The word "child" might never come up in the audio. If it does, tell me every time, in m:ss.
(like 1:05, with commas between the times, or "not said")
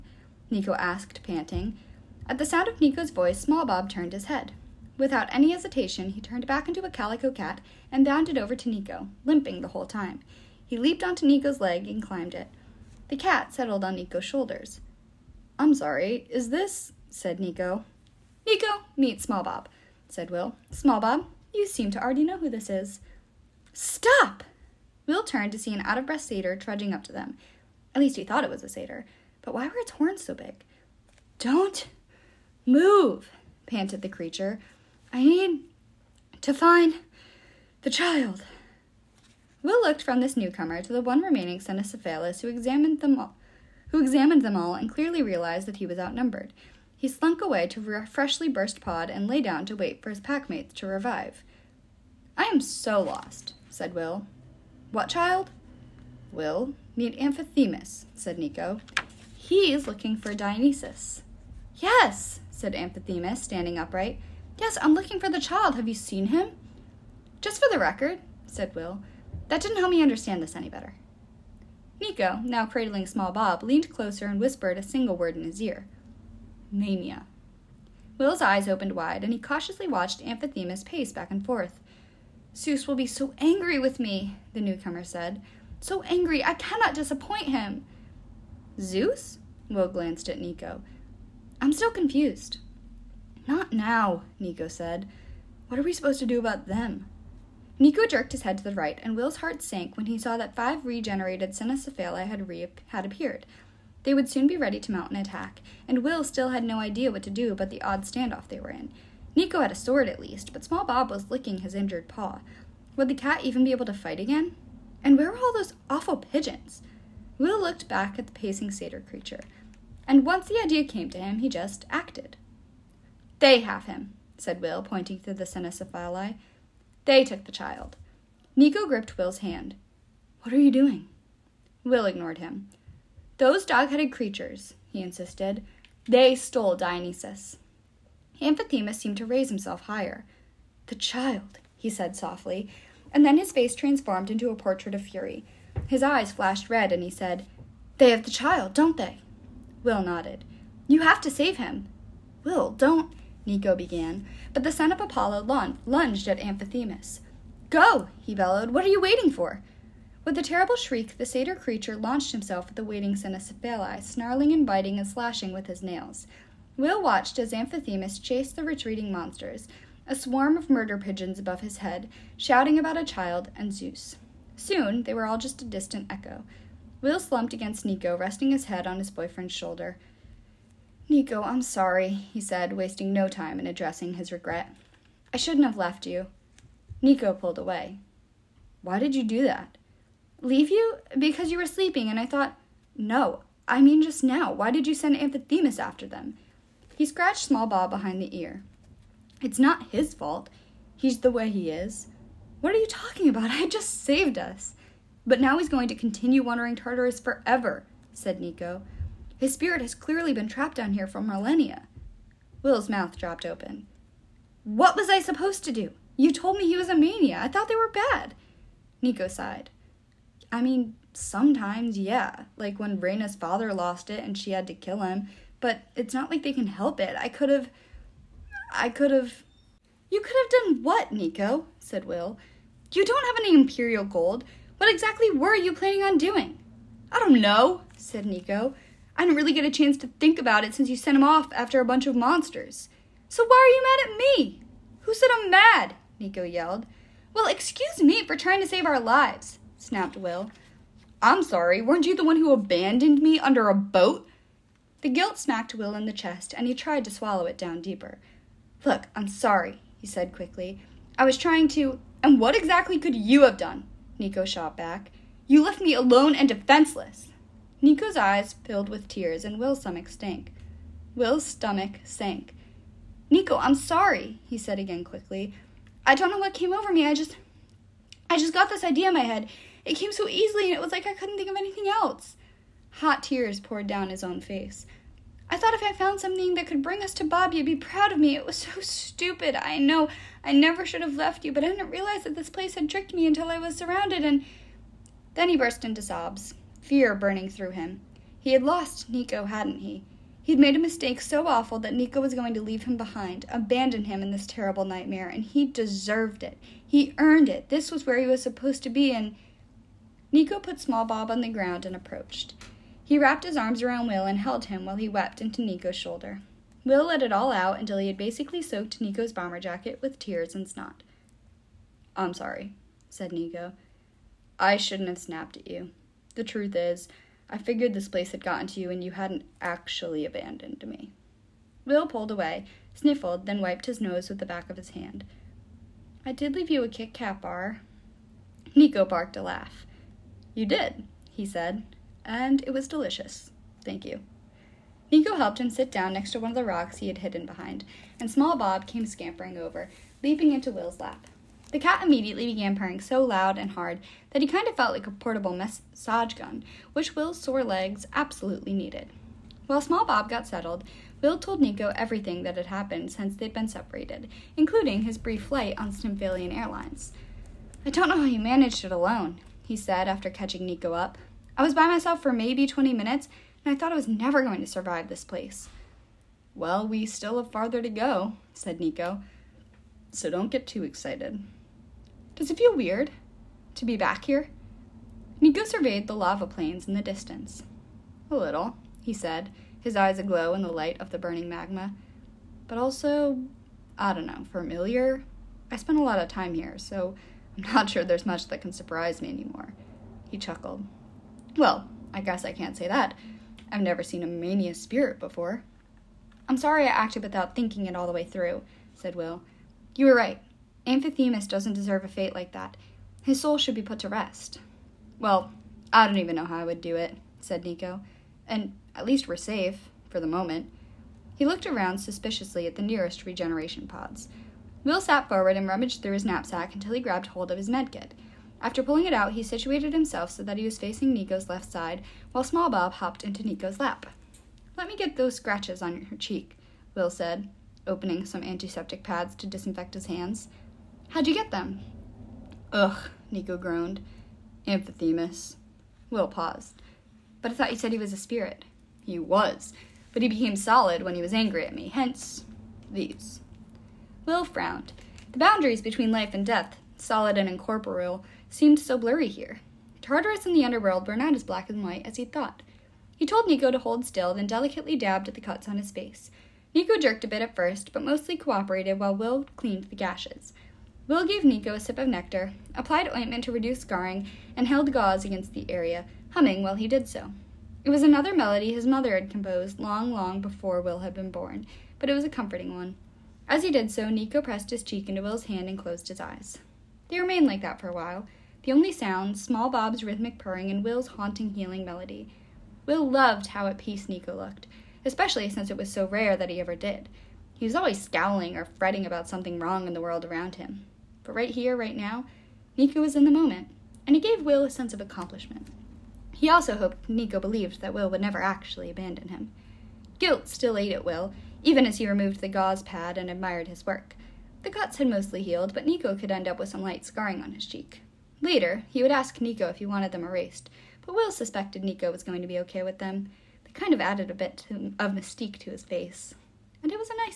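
0:37, 0:55, 1:05, 2:07, 2:20, 2:28, 2:53.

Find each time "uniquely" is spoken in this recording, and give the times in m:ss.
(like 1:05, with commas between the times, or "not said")
not said.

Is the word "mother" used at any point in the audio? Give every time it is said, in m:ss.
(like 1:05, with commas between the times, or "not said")
7:58.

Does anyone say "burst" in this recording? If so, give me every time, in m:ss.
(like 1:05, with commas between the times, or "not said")
0:48, 4:55.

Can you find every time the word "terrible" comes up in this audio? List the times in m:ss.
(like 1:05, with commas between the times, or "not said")
2:40, 5:04.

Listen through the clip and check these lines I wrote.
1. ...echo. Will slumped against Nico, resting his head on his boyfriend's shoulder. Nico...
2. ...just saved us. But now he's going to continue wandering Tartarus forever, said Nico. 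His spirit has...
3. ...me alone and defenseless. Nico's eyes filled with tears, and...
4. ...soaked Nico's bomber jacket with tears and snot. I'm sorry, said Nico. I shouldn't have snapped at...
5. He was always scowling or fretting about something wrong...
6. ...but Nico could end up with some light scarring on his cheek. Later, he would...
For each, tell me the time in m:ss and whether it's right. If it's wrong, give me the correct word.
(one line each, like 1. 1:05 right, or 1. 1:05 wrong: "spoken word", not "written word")
1. 2:56 right
2. 3:23 right
3. 4:25 right
4. 5:18 right
5. 8:17 right
6. 8:35 right.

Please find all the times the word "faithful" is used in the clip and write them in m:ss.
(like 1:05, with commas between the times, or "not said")
not said.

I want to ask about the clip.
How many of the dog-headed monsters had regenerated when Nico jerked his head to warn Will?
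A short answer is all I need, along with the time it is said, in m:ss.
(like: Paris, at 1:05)
5, at 1:40.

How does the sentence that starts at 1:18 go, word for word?
Will's eyes opened wide, and he cautiously watched Amphithemus pace back and forth.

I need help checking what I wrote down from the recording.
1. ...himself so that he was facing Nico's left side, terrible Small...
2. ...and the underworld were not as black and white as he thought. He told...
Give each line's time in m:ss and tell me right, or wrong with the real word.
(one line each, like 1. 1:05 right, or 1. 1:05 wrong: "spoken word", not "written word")
1. 7:09 wrong: "while", not "terrible"
2. 7:40 right.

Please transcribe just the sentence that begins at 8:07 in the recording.
They remained like that for a while, the only sounds small Bob's rhythmic purring and Will's haunting, healing melody.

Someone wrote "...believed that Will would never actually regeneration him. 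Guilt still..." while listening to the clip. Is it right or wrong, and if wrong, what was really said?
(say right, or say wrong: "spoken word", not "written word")
wrong: "abandon", not "regeneration".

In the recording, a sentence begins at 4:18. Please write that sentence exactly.
Look, I'm sorry, he said quickly.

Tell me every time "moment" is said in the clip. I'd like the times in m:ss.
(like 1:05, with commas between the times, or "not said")
7:00, 8:23.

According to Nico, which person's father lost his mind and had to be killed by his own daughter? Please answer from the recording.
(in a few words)
Reyna.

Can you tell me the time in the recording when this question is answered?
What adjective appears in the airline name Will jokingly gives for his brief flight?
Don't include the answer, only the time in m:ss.
6:05.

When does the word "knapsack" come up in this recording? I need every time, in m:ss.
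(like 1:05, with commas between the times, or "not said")
7:06.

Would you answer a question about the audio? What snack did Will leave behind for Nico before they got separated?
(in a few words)
Kit Kat bar.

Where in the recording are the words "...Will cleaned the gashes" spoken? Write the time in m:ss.
7:49.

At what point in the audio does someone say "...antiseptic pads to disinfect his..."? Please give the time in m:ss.
7:18.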